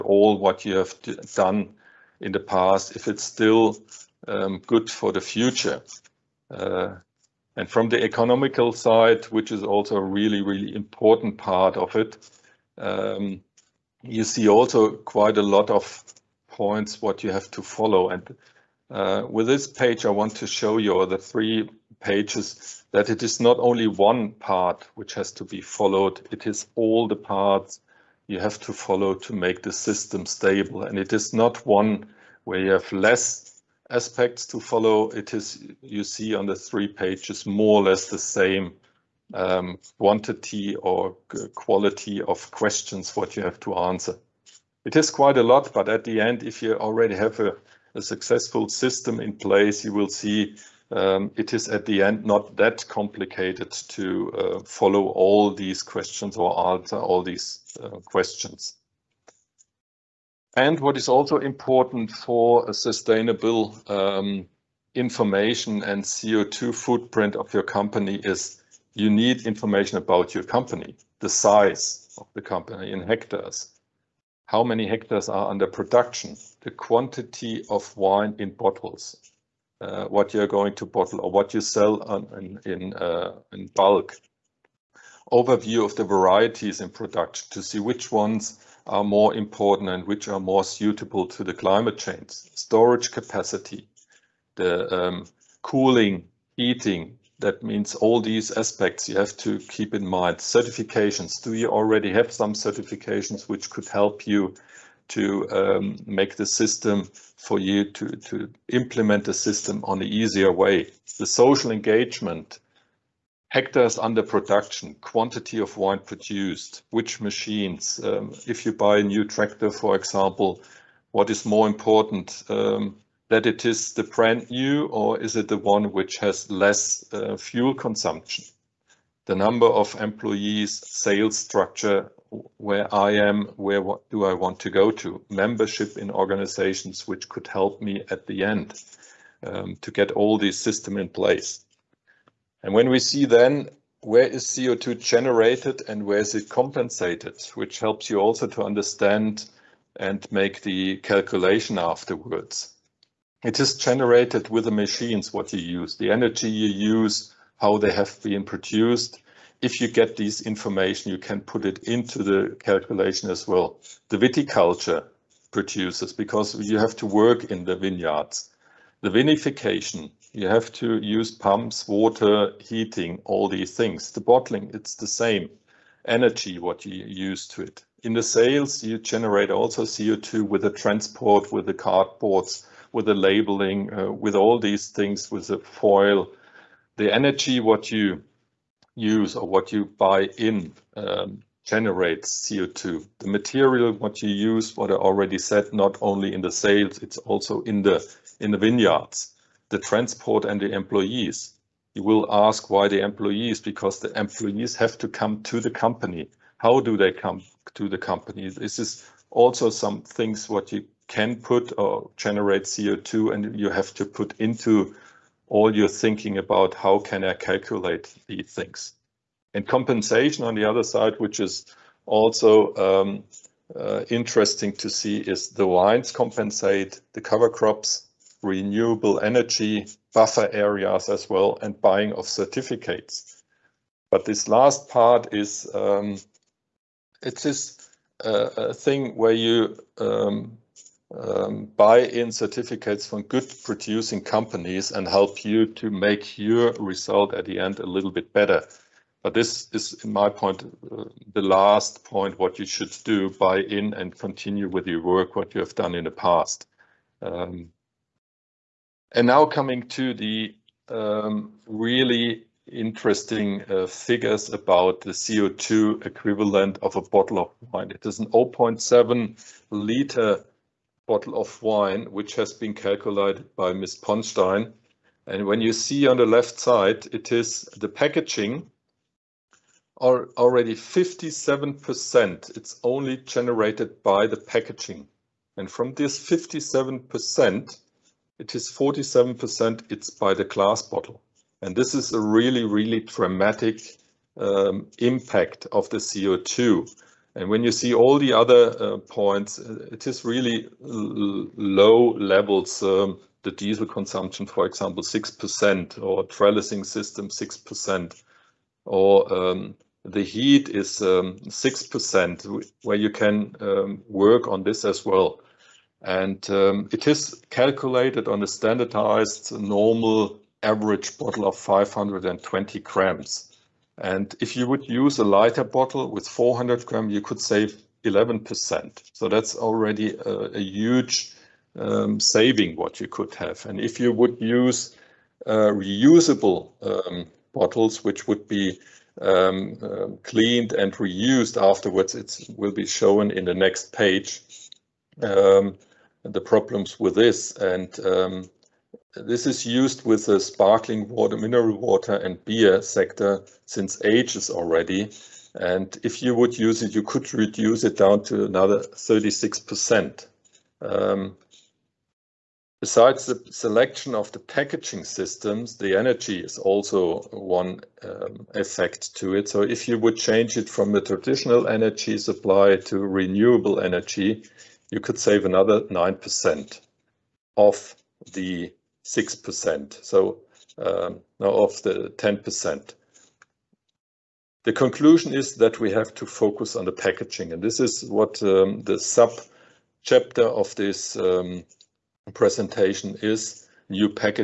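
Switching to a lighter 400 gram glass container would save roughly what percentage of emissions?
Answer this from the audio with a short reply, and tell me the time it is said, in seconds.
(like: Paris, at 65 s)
11%, at 328 s.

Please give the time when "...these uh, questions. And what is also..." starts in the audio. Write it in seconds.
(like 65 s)
57 s.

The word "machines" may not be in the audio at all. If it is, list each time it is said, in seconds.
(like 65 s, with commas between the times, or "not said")
117 s, 154 s.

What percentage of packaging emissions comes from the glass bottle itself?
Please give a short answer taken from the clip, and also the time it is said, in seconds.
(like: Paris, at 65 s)
47%, at 288 s.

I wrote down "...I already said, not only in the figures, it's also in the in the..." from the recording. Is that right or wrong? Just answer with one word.
wrong.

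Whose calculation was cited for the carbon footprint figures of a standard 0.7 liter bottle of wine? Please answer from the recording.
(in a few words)
Ms. Ponstein.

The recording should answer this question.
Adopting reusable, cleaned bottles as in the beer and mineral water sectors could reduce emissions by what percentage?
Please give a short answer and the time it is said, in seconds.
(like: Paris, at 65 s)
36%, at 358 s.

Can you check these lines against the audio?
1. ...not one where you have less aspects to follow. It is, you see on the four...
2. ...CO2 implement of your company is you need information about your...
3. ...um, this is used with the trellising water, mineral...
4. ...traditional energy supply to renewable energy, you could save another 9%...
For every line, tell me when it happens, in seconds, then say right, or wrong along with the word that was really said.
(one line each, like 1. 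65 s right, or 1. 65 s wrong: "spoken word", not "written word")
1. 31 s wrong: "three", not "four"
2. 66 s wrong: "footprint", not "implement"
3. 348 s wrong: "sparkling", not "trellising"
4. 371 s right.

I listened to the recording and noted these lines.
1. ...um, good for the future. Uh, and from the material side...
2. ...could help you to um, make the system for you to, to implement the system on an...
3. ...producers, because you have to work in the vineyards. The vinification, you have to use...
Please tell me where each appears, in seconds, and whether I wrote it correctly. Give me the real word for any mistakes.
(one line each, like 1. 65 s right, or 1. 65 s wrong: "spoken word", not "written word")
1. 4 s wrong: "economical", not "material"
2. 103 s right
3. 165 s right.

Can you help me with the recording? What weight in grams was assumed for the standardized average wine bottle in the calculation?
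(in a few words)
520 grams.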